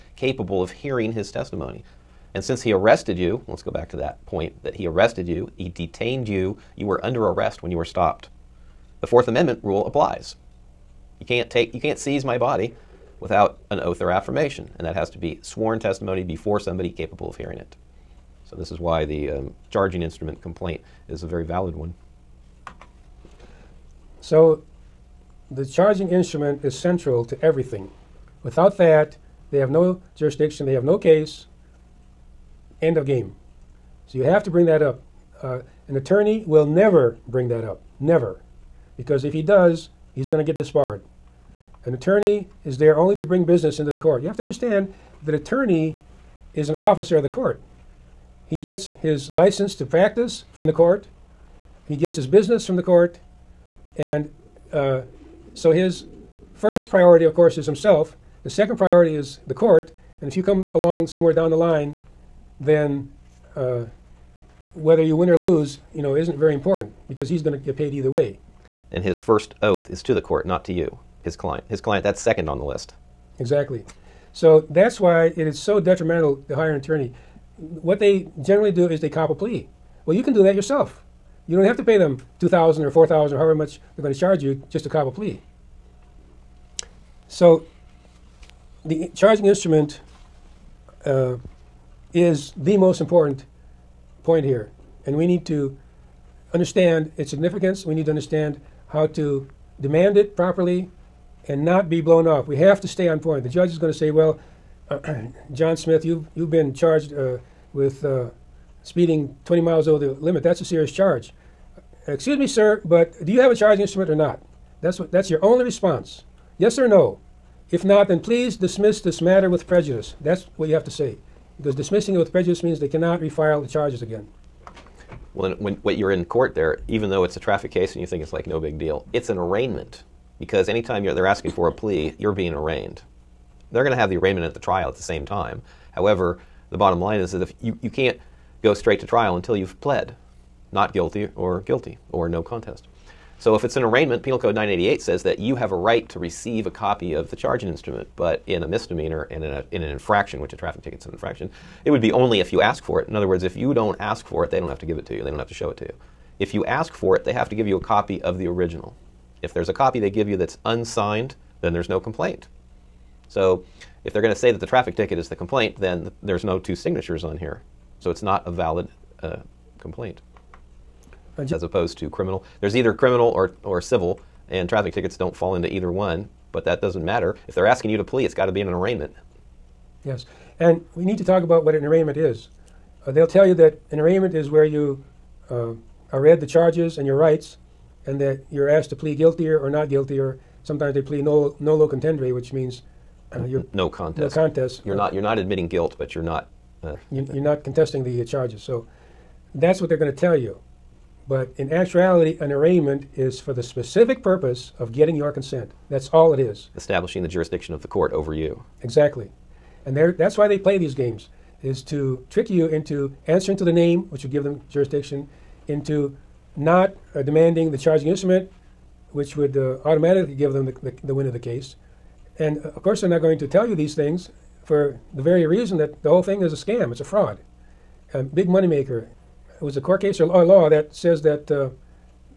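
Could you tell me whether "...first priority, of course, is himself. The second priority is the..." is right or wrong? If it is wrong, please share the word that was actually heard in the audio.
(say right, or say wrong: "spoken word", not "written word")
right.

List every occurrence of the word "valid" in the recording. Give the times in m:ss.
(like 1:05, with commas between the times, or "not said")
0:21, 2:48.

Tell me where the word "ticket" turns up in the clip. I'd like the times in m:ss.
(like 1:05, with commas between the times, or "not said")
2:30, 2:44, 2:54.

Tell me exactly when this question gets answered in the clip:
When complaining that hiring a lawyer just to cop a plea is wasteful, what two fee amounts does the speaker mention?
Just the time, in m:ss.
1:22.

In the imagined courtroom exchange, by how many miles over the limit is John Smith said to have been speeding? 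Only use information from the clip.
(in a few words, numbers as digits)
20.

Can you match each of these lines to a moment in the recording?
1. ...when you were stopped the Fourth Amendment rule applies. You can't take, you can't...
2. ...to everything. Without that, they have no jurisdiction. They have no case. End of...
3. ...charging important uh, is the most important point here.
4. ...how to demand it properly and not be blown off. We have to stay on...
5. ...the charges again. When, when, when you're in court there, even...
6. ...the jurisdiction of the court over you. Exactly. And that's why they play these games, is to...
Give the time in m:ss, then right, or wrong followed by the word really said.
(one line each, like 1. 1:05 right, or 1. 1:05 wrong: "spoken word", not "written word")
1. 0:07 right
2. 0:27 right
3. 1:29 wrong: "instrument", not "important"
4. 1:38 right
5. 2:03 right
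6. 3:27 right.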